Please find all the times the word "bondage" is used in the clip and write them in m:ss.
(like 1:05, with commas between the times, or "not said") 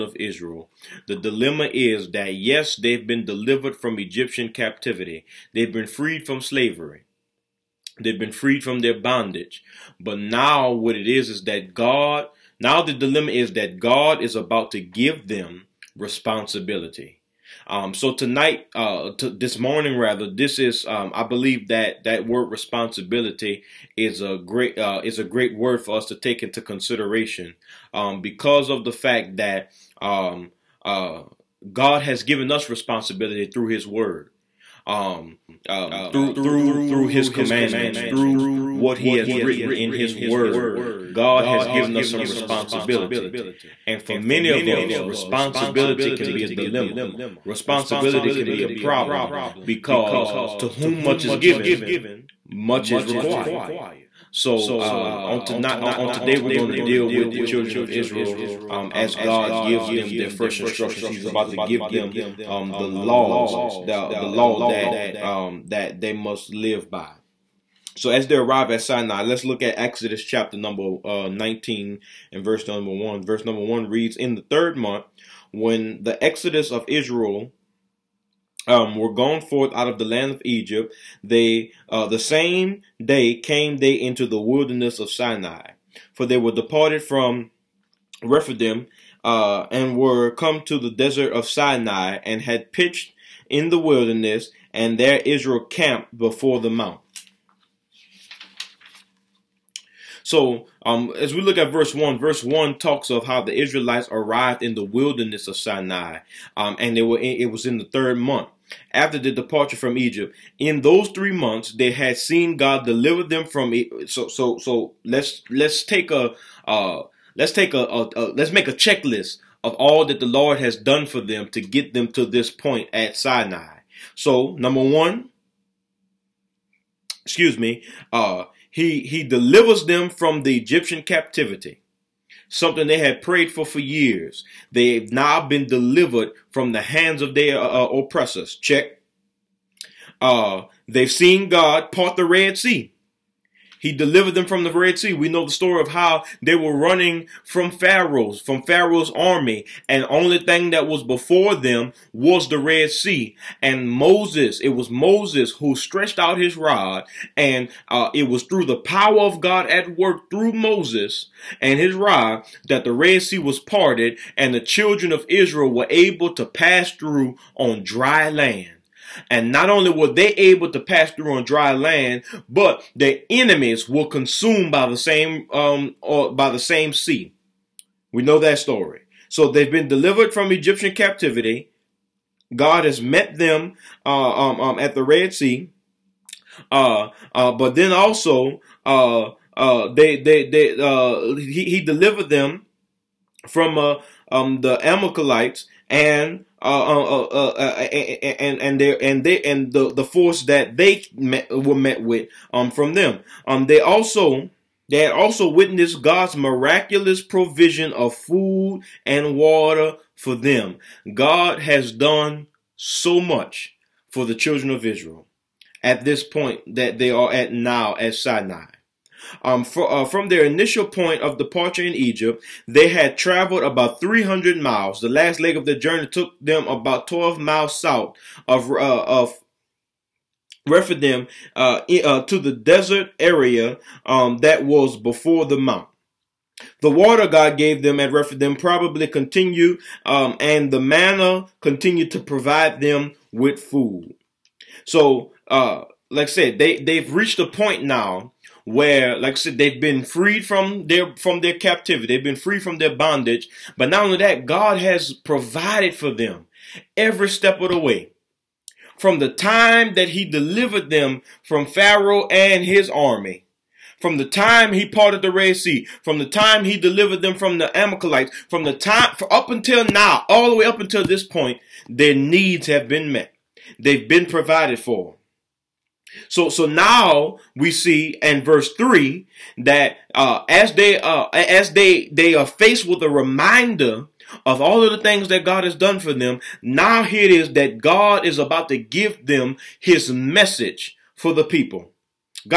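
0:08, 4:12.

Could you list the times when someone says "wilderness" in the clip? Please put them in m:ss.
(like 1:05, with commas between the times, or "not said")
1:24, 1:33, 1:44.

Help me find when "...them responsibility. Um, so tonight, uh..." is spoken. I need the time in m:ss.
0:15.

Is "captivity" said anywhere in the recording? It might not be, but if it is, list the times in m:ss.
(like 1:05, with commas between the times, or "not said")
0:04, 2:11, 3:00, 4:11.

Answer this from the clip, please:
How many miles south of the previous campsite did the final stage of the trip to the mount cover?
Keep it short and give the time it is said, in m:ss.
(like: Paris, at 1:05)
12 miles, at 3:47.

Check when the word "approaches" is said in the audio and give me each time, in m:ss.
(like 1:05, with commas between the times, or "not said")
not said.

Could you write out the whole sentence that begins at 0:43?
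And for many of us, responsibility can be a dilemma.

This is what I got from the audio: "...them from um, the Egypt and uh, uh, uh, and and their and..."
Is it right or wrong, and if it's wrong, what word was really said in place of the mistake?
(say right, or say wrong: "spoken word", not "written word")
wrong: "Amalekites", not "Egypt".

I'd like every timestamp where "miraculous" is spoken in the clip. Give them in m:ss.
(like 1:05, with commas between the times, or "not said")
3:26.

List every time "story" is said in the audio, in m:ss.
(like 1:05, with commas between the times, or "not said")
2:25, 2:58.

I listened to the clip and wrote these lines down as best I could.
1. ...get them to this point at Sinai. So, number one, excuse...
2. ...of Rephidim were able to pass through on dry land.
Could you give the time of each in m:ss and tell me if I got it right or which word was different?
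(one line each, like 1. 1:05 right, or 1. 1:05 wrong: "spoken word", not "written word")
1. 2:01 right
2. 2:45 wrong: "Israel", not "Rephidim".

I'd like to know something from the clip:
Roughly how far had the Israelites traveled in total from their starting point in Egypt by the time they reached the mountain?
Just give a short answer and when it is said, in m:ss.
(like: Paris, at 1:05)
300 miles, at 3:43.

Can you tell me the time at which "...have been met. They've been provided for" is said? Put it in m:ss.
4:32.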